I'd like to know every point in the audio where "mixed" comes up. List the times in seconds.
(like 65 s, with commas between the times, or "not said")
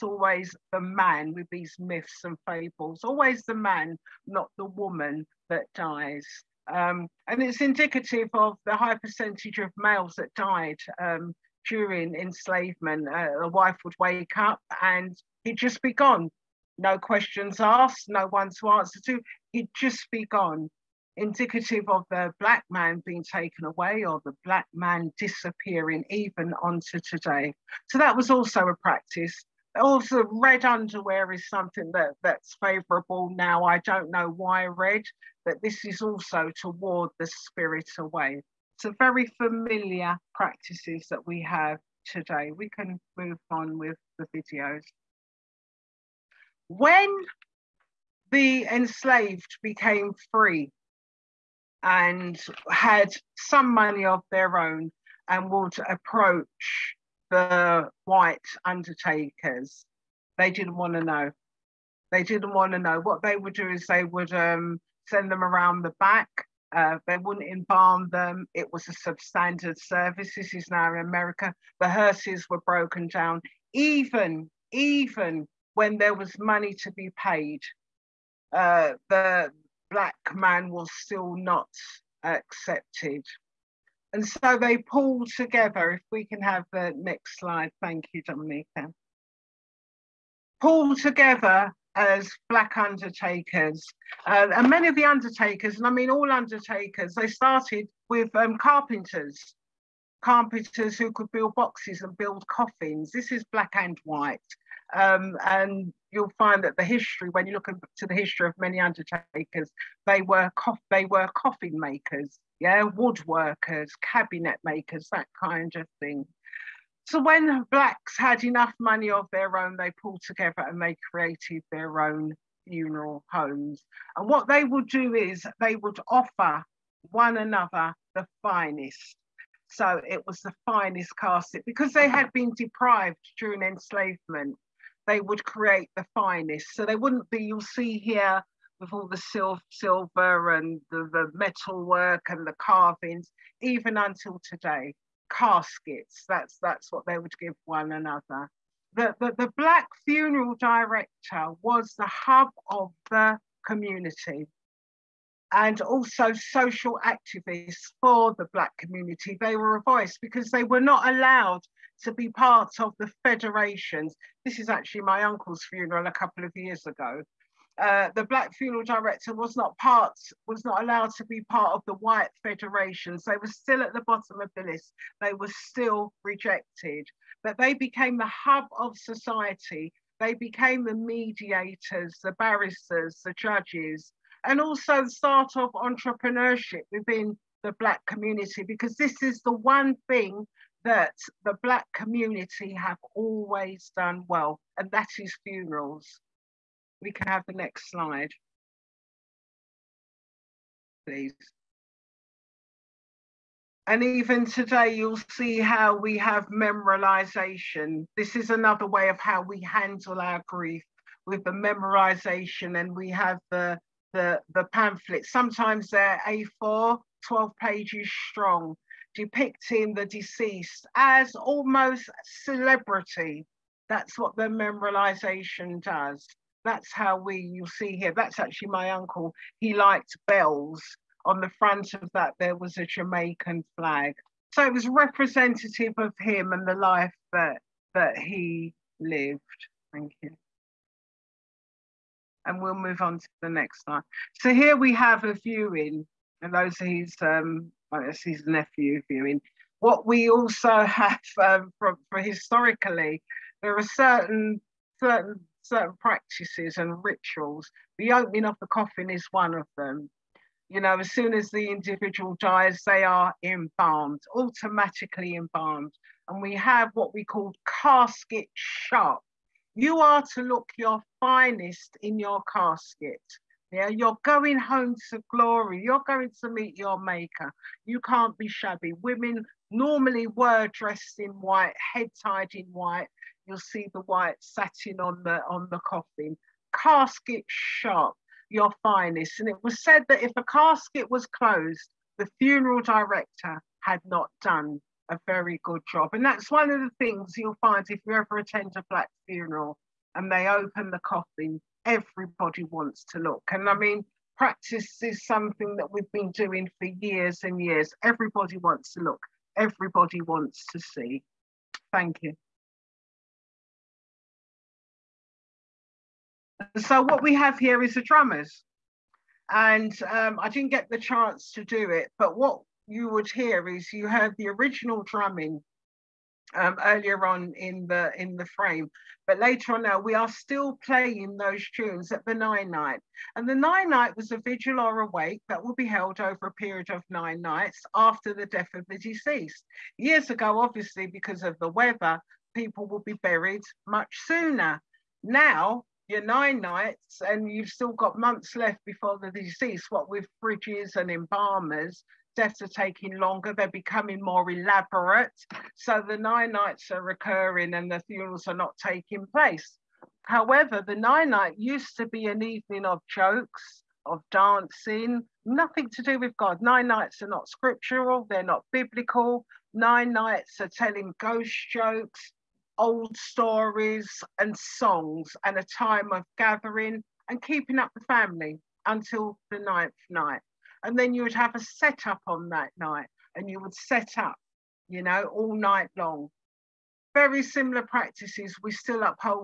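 not said.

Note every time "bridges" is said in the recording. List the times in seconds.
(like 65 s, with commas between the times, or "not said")
350 s.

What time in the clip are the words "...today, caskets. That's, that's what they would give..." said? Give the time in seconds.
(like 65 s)
144 s.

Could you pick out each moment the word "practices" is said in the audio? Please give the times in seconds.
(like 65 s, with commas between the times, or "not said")
28 s, 40 s, 255 s, 304 s, 387 s.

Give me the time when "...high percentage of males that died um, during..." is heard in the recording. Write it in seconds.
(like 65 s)
8 s.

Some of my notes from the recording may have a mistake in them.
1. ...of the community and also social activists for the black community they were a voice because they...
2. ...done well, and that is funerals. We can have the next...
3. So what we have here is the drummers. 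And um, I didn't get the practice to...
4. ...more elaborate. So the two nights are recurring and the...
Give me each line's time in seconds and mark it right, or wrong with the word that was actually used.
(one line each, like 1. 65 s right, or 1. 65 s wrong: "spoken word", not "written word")
1. 152 s right
2. 193 s right
3. 316 s wrong: "chance", not "practice"
4. 354 s wrong: "nine", not "two".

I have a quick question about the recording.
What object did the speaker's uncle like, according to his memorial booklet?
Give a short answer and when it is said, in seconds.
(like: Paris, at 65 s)
bells, at 230 s.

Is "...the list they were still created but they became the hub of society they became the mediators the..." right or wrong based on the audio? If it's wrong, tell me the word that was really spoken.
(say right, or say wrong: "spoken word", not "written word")
wrong: "rejected", not "created".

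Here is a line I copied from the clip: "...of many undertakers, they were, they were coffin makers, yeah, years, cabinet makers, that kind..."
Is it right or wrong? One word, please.
wrong.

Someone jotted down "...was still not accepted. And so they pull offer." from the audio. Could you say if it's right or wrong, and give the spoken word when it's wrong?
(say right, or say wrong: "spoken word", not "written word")
wrong: "together", not "offer".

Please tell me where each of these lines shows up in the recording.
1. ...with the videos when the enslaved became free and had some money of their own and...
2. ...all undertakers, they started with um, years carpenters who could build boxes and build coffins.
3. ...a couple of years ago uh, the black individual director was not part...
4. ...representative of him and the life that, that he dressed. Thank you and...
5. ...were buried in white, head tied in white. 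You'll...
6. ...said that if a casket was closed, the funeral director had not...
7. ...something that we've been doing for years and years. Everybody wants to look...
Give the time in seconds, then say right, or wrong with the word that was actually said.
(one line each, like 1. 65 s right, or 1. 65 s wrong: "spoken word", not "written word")
1. 43 s right
2. 96 s wrong: "carpenters", not "years"
3. 166 s wrong: "funeral", not "individual"
4. 234 s wrong: "lived", not "dressed"
5. 280 s wrong: "dressed", not "buried"
6. 289 s right
7. 305 s right.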